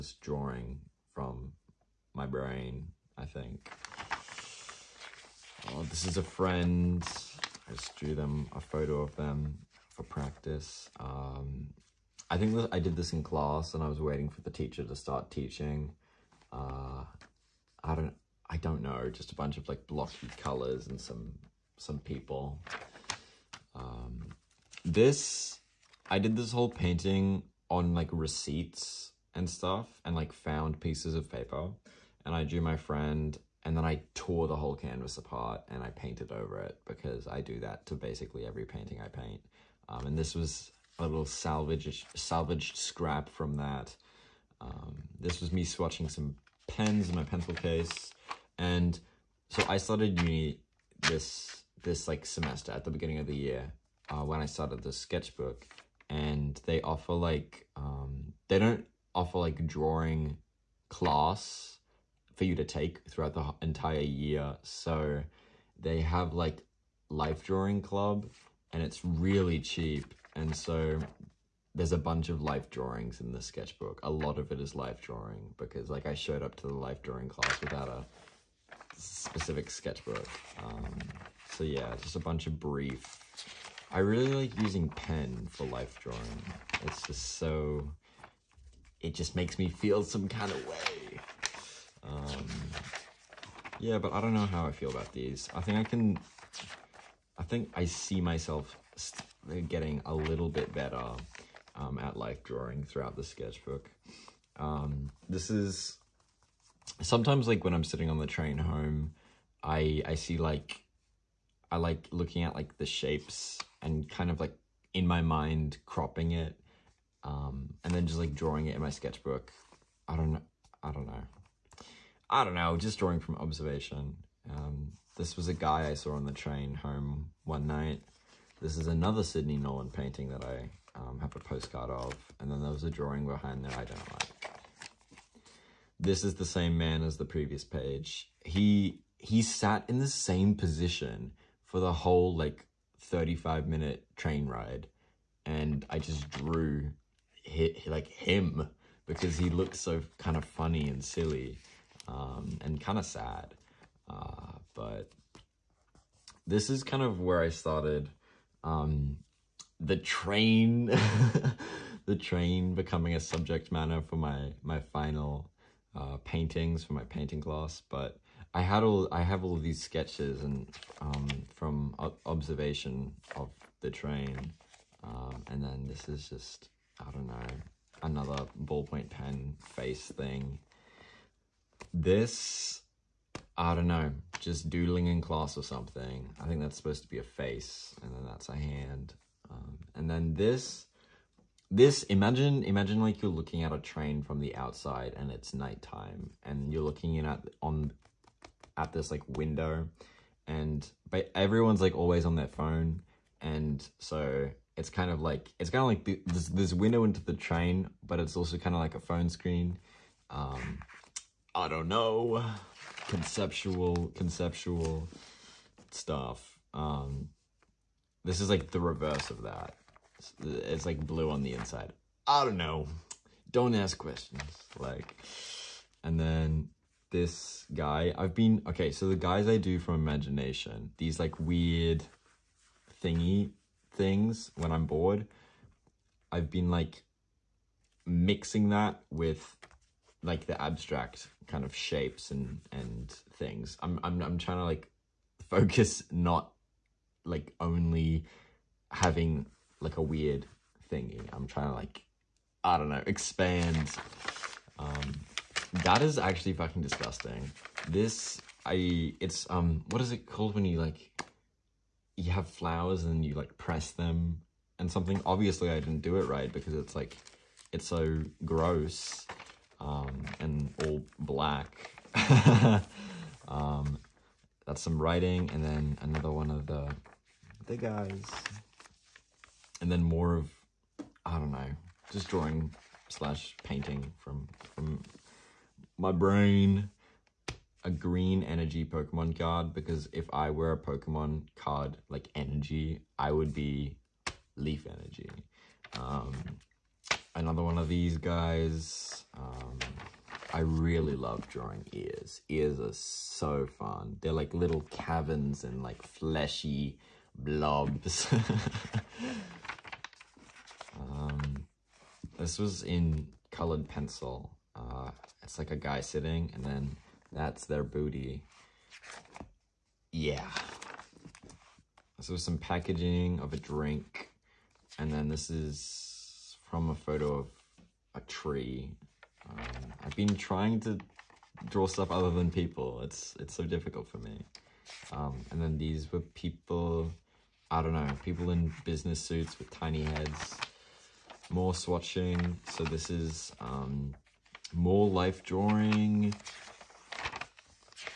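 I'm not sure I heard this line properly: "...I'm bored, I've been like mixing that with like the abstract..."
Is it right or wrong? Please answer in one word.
right.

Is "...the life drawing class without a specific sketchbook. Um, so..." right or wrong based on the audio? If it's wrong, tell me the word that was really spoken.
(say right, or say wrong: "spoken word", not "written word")
right.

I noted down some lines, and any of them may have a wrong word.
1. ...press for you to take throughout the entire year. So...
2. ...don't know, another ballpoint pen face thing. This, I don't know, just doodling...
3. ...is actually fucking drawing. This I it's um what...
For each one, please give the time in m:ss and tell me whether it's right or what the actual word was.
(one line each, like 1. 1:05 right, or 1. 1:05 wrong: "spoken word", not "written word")
1. 1:00 wrong: "class", not "press"
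2. 2:57 right
3. 4:16 wrong: "disgusting", not "drawing".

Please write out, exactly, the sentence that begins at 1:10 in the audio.
And so there's a bunch of life drawings in the sketchbook.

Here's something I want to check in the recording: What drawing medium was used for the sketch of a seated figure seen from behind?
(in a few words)
Colored pencil.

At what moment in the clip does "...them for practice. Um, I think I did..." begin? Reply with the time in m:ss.
0:09.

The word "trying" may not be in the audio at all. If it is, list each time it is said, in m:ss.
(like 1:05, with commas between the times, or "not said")
4:04, 4:11, 5:30.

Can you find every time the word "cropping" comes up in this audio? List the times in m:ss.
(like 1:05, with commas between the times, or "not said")
1:55.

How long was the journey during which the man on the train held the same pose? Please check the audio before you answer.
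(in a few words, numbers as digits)
35 minutes.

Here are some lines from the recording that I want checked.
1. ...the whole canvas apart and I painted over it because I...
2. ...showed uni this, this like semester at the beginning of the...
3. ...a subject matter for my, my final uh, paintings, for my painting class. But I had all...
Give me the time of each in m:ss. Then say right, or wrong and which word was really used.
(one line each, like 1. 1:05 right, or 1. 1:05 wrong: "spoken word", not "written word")
1. 0:34 right
2. 0:49 wrong: "started", not "showed"
3. 2:43 right.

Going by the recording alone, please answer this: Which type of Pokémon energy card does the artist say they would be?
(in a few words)
Leaf Energy.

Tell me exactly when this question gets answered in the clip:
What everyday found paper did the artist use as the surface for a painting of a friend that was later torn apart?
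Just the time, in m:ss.
0:28.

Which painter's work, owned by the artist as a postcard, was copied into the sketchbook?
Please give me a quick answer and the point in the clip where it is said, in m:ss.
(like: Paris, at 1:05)
Sidney Nolan, at 2:09.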